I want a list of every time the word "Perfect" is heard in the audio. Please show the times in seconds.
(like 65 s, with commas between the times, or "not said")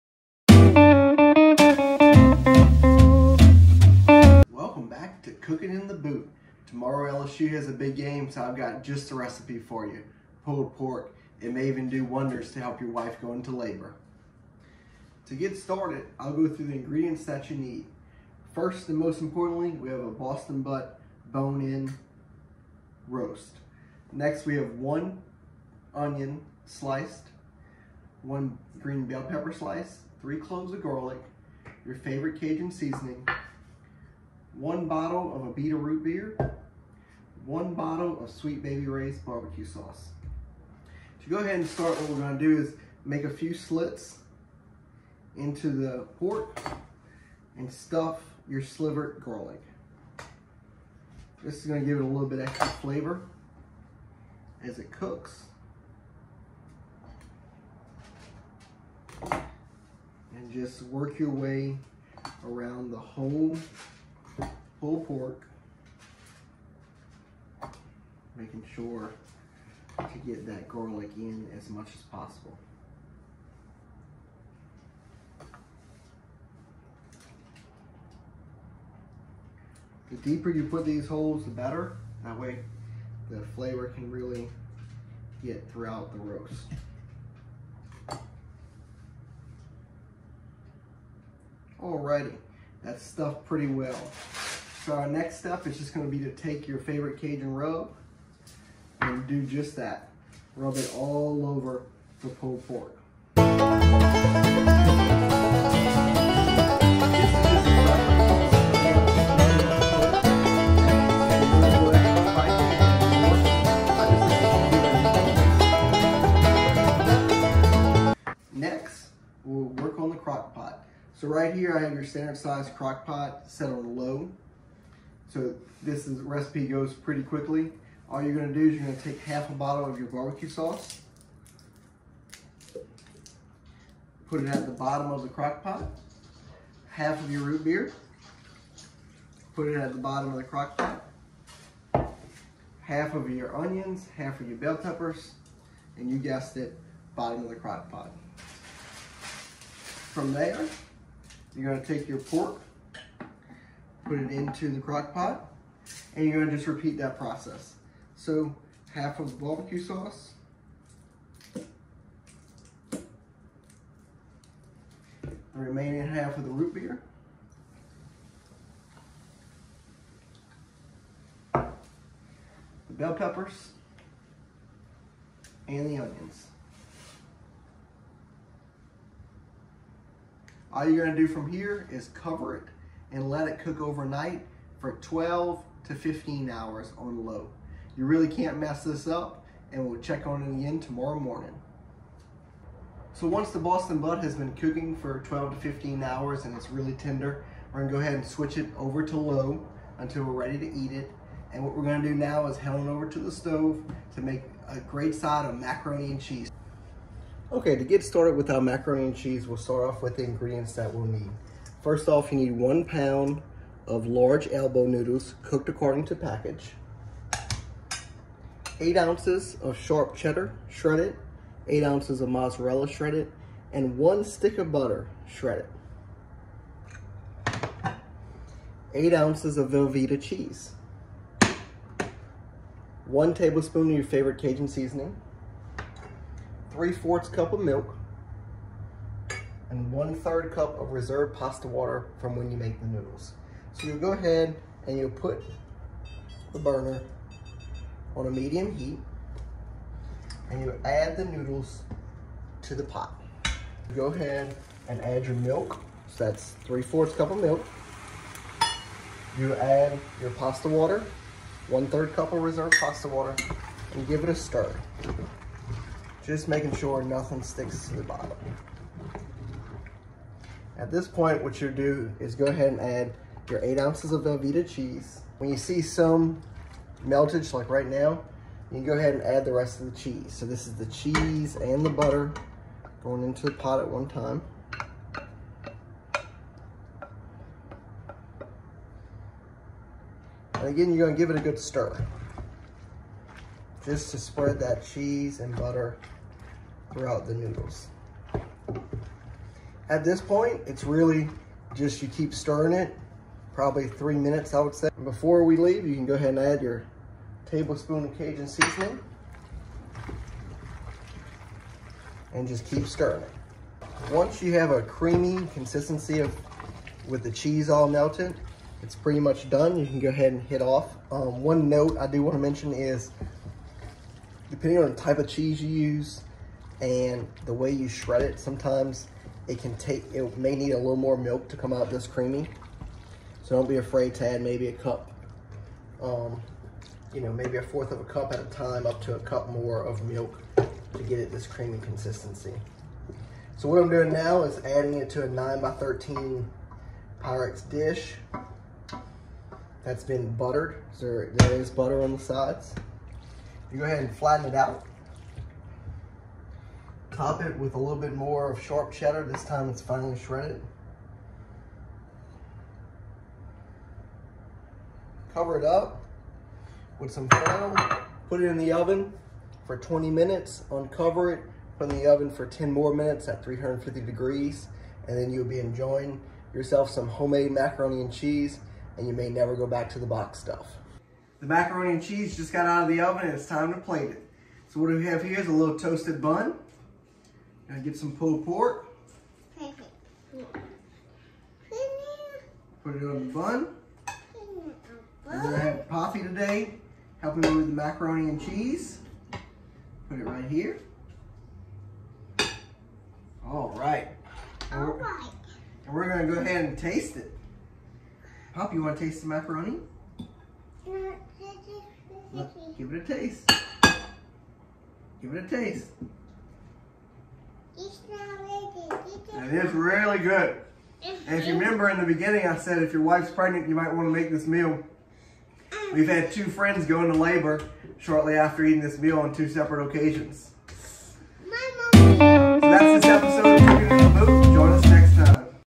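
389 s.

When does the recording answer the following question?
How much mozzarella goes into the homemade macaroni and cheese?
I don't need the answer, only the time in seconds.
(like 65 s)
221 s.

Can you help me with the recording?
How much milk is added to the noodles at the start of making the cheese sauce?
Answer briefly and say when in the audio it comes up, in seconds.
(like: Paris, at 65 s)
3/4 cup, at 256 s.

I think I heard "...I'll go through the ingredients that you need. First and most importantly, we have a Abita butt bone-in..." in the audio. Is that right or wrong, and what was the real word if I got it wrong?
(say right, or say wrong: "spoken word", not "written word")
wrong: "Boston", not "Abita".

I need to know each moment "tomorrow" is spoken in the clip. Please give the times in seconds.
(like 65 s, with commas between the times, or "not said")
6 s, 190 s.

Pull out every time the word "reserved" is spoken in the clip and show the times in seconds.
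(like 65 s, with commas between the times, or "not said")
240 s, 262 s.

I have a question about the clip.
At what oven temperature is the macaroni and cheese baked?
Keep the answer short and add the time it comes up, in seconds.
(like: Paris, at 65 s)
350 degrees, at 373 s.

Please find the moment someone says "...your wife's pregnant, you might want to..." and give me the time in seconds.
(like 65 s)
422 s.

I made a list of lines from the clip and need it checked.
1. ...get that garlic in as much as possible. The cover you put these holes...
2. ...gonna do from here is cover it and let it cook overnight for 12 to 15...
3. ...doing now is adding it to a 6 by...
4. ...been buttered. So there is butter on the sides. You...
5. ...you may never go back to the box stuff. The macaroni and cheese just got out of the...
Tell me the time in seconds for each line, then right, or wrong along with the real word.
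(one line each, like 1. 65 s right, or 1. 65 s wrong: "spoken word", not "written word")
1. 70 s wrong: "deeper", not "cover"
2. 181 s right
3. 343 s wrong: "9", not "6"
4. 350 s right
5. 379 s right.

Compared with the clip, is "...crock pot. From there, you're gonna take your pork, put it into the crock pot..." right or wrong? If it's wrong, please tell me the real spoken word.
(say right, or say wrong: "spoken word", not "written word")
right.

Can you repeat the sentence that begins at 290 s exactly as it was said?
And again, you're gonna give it a good stir.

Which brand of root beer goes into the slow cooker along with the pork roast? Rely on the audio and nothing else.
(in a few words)
Abita.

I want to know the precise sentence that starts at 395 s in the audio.
We're gonna have Poppy today, helping me with the macaroni and cheese.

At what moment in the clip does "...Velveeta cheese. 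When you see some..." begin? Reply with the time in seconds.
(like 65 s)
274 s.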